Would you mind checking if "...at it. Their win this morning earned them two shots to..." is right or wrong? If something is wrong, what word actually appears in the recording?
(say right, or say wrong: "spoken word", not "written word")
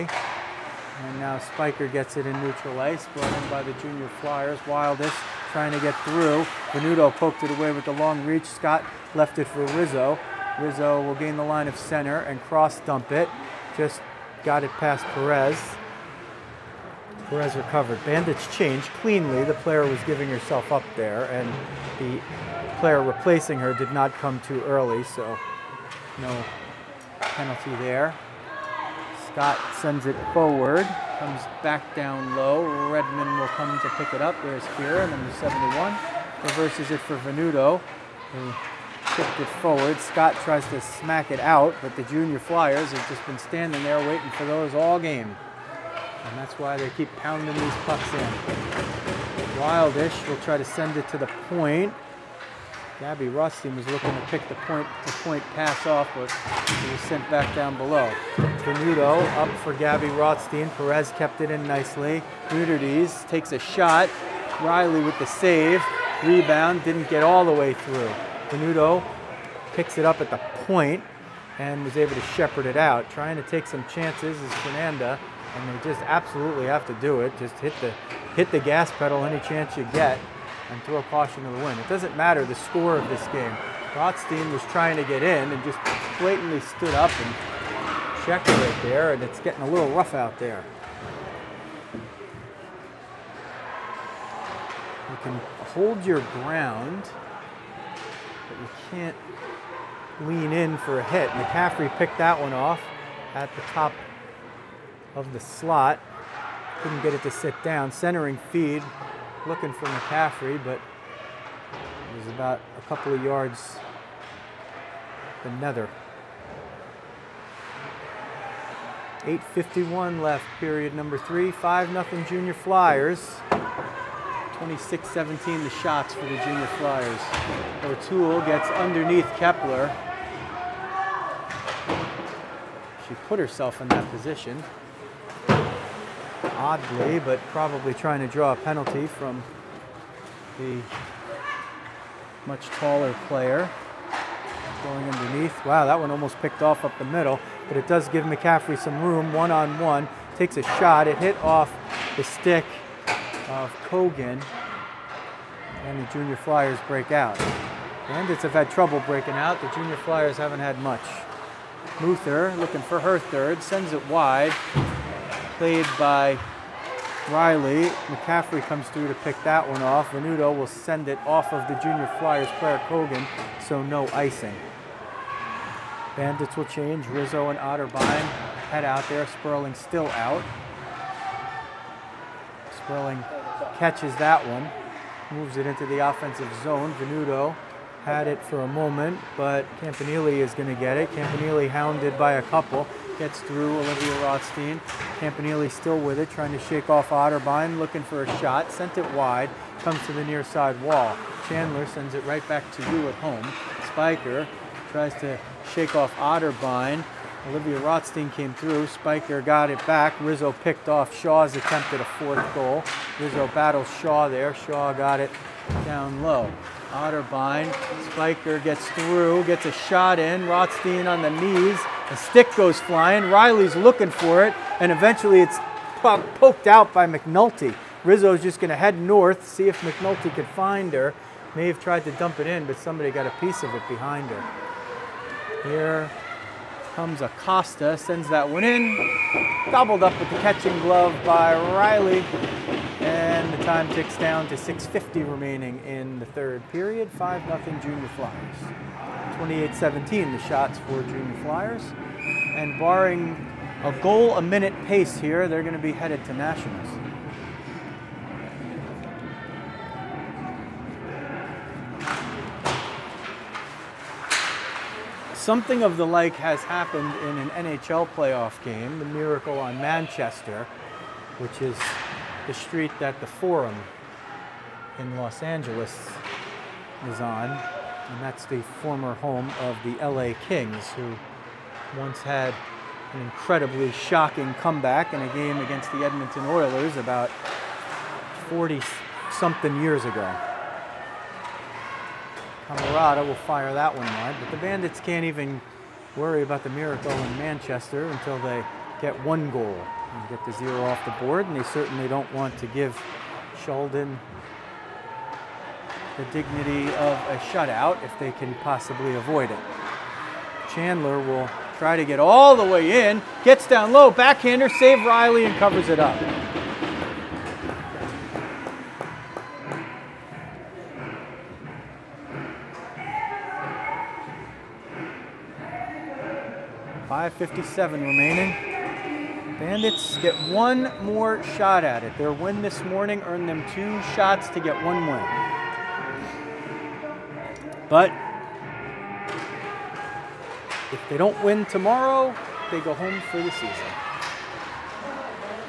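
right.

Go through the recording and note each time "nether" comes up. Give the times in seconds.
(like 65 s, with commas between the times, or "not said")
115 s.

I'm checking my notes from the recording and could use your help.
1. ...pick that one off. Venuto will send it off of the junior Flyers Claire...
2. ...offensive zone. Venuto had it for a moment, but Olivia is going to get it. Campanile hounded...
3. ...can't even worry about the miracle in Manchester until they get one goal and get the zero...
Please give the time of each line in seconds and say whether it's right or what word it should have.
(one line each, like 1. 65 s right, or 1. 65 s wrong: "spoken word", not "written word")
1. 169 s right
2. 186 s wrong: "Campanile", not "Olivia"
3. 294 s right.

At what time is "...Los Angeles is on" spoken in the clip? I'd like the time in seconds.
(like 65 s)
275 s.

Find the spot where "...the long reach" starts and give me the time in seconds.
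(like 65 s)
7 s.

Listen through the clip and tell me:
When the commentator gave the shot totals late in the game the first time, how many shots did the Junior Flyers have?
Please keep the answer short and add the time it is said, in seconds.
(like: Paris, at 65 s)
26, at 124 s.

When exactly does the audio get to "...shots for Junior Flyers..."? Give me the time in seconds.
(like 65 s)
250 s.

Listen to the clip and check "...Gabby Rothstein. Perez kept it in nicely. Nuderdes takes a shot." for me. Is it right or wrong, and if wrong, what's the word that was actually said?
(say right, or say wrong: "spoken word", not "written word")
right.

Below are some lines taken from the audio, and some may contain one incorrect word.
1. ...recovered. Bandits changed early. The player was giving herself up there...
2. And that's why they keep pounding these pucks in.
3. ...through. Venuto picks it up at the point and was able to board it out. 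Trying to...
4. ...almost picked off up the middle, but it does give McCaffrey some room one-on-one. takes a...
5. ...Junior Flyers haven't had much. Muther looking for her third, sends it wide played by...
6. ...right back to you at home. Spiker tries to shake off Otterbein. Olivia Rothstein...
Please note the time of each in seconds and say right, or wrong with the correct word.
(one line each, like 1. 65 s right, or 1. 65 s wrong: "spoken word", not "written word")
1. 17 s wrong: "cleanly", not "early"
2. 46 s right
3. 67 s wrong: "shepherd", not "board"
4. 146 s right
5. 159 s right
6. 202 s right.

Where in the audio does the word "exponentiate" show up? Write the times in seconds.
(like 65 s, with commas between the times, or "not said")
not said.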